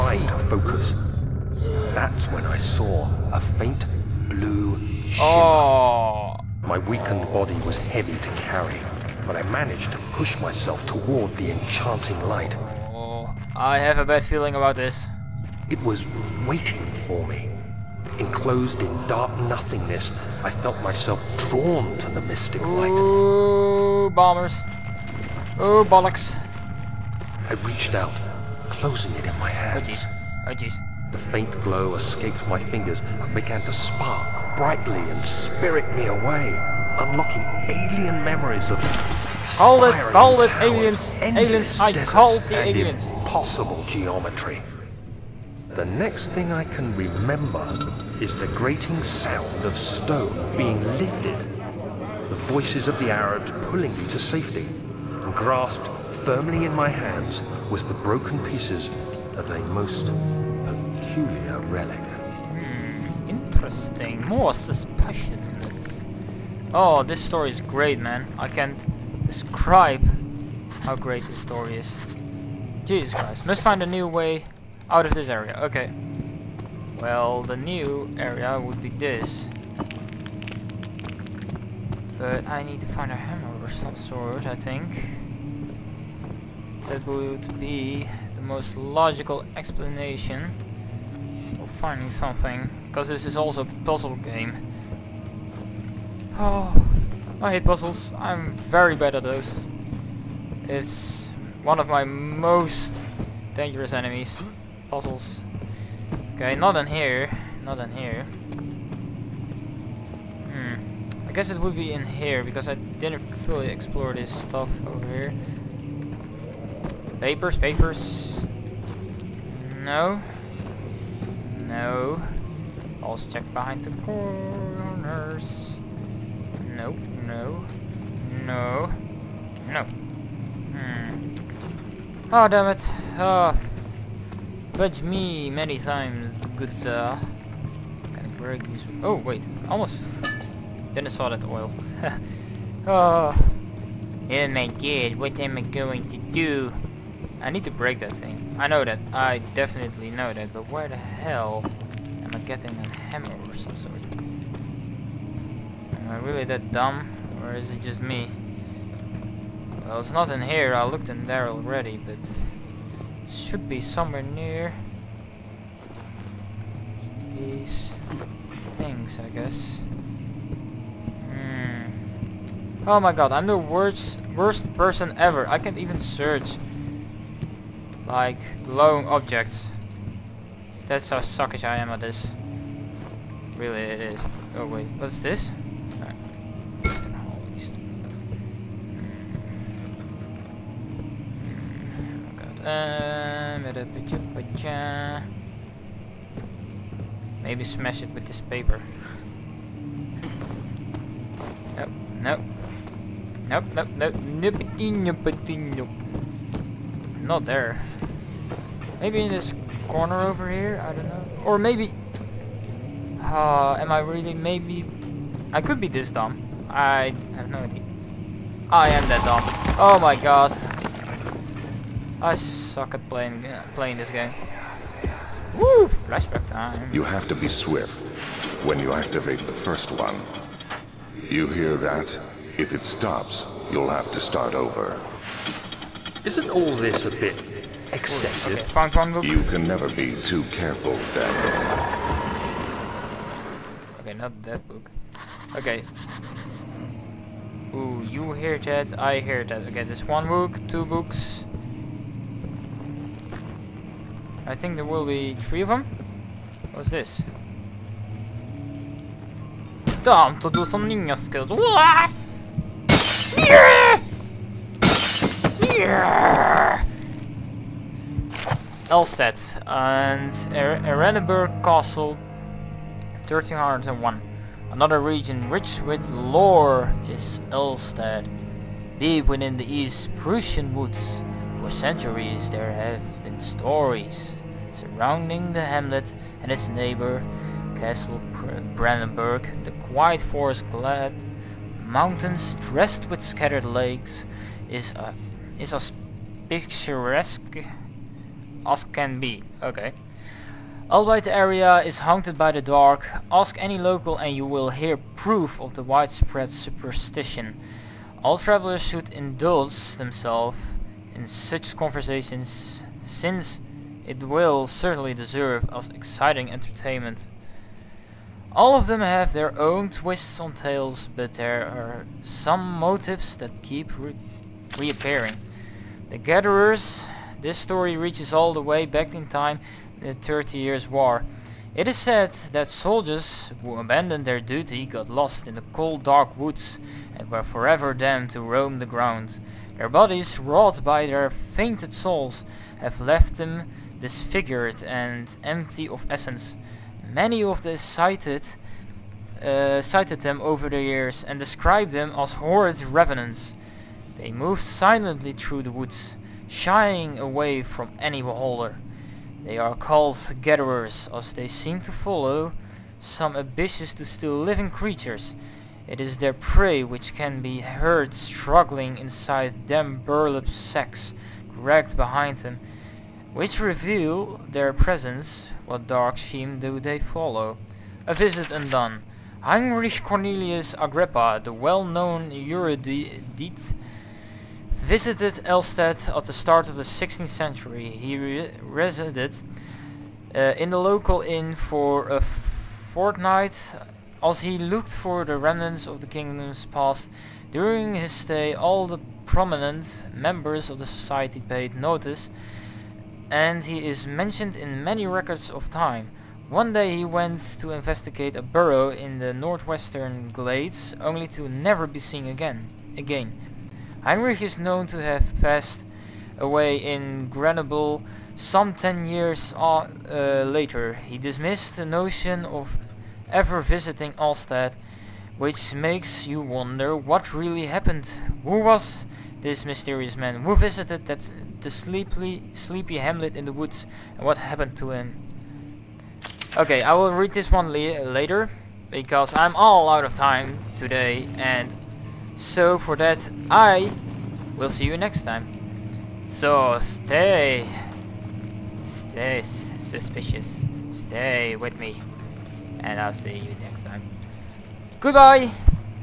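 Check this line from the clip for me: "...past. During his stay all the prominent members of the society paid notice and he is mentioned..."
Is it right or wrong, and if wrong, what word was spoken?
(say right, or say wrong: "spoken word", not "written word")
right.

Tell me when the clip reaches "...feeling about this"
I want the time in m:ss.
0:14.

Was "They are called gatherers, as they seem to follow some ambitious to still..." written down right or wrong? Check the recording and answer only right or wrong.
right.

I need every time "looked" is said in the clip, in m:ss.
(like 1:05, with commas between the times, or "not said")
2:40, 6:34.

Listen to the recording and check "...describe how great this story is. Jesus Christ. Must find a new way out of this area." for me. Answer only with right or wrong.
right.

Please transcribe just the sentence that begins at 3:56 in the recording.
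Isn't all this a bit excessive?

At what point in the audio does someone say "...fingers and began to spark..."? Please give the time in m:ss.
0:32.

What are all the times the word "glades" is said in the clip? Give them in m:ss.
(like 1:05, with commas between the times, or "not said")
6:50.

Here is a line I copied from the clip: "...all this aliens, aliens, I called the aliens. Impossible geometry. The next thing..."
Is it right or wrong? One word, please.
right.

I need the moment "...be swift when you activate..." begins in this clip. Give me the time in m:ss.
3:47.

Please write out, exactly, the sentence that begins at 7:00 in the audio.
He dismissed the notion of ever visiting Altstadt, which makes you wonder what really happened.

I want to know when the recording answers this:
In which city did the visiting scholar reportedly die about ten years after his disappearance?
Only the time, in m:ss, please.
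6:57.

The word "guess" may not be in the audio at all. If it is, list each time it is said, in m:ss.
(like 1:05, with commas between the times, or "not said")
1:51, 2:49.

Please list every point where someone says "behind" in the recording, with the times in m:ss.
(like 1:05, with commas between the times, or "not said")
2:03, 6:11.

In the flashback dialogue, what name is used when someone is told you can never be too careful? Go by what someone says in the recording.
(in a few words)
Daniel.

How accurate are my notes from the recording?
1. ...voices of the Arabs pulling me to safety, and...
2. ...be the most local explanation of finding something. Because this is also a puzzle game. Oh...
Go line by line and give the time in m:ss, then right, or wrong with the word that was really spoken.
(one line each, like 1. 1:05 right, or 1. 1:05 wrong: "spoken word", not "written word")
1. 0:52 right
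2. 1:27 wrong: "logical", not "local".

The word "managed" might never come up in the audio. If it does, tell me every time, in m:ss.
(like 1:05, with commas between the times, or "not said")
0:09.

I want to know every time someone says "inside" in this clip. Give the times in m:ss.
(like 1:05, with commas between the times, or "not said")
6:08.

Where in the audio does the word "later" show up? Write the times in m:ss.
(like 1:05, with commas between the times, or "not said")
7:00, 7:17.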